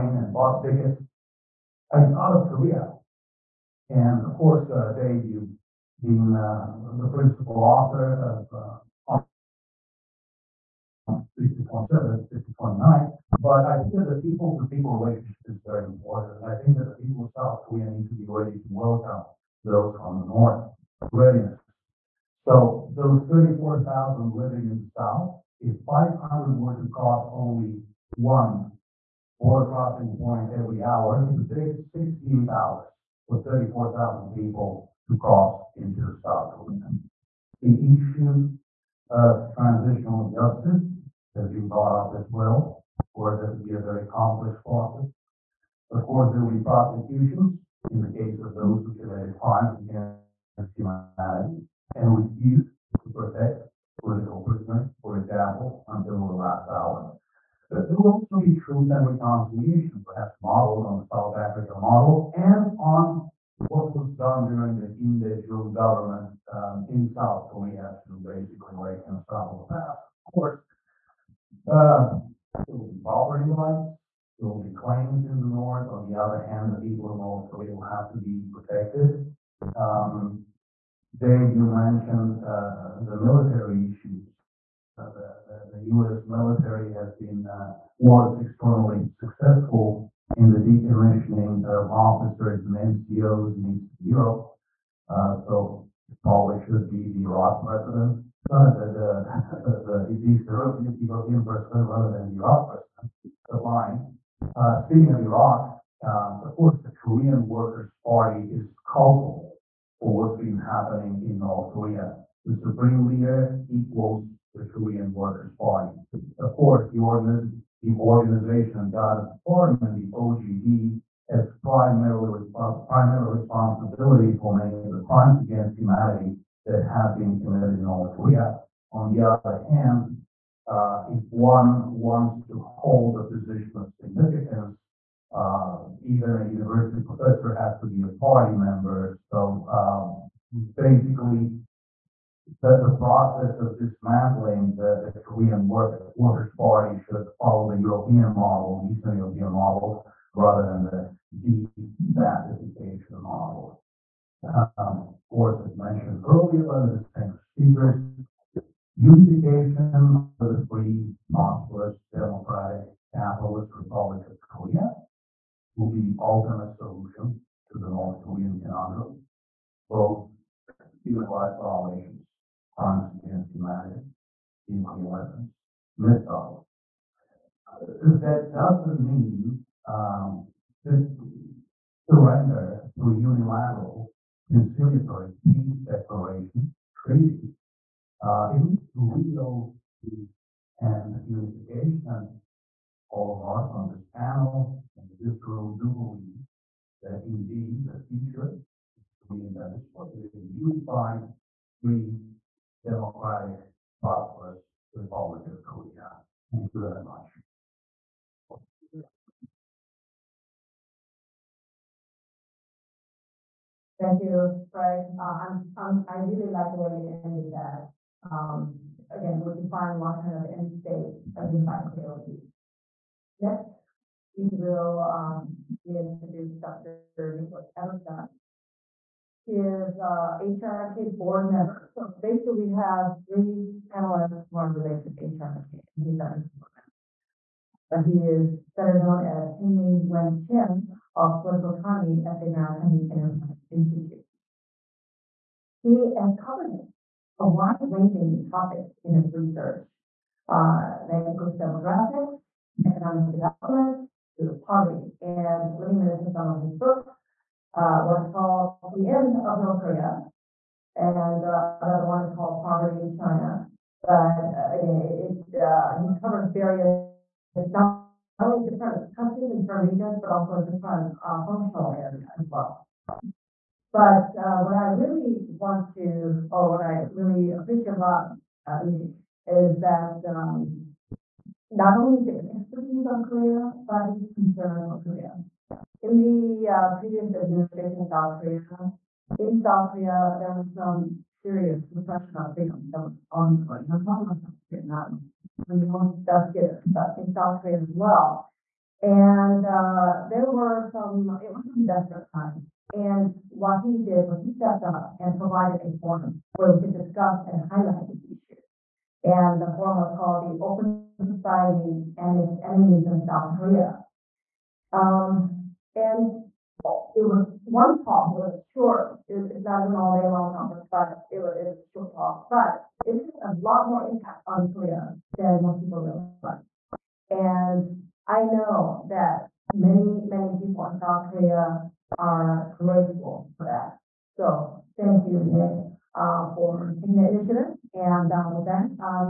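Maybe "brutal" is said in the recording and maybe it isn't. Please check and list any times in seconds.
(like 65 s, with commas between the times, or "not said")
not said.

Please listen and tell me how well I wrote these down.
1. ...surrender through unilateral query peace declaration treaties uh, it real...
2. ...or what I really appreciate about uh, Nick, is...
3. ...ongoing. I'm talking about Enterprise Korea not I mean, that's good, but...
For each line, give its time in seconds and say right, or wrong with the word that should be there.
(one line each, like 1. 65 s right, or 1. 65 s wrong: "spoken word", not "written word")
1. 182 s wrong: "conciliatory", not "query"
2. 276 s right
3. 293 s wrong: "South", not "Enterprise".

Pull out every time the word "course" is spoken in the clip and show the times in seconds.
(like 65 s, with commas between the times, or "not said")
4 s, 46 s, 70 s, 106 s, 116 s, 155 s.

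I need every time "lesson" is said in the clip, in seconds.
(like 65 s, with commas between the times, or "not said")
not said.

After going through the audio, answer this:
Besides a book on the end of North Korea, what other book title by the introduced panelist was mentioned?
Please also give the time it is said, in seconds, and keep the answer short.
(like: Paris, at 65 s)
Poverty in China, at 262 s.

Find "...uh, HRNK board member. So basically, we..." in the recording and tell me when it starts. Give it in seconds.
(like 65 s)
230 s.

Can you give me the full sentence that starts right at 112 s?
The supreme leader equals the Korean Workers' Party.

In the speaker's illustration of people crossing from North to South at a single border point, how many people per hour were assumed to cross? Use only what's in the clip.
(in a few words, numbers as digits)
500.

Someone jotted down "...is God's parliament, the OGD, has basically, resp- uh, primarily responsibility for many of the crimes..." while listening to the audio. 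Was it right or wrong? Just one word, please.
wrong.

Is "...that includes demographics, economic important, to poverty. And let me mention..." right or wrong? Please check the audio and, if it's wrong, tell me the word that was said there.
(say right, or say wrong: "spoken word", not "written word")
wrong: "development", not "important".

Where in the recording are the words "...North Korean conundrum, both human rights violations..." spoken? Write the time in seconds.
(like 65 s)
167 s.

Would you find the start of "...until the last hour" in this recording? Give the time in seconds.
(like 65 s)
55 s.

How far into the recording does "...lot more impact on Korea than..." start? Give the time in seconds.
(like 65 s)
323 s.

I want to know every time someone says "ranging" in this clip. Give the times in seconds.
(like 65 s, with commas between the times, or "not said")
247 s.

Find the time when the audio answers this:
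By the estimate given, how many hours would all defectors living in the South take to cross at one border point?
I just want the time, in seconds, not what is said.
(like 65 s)
31 s.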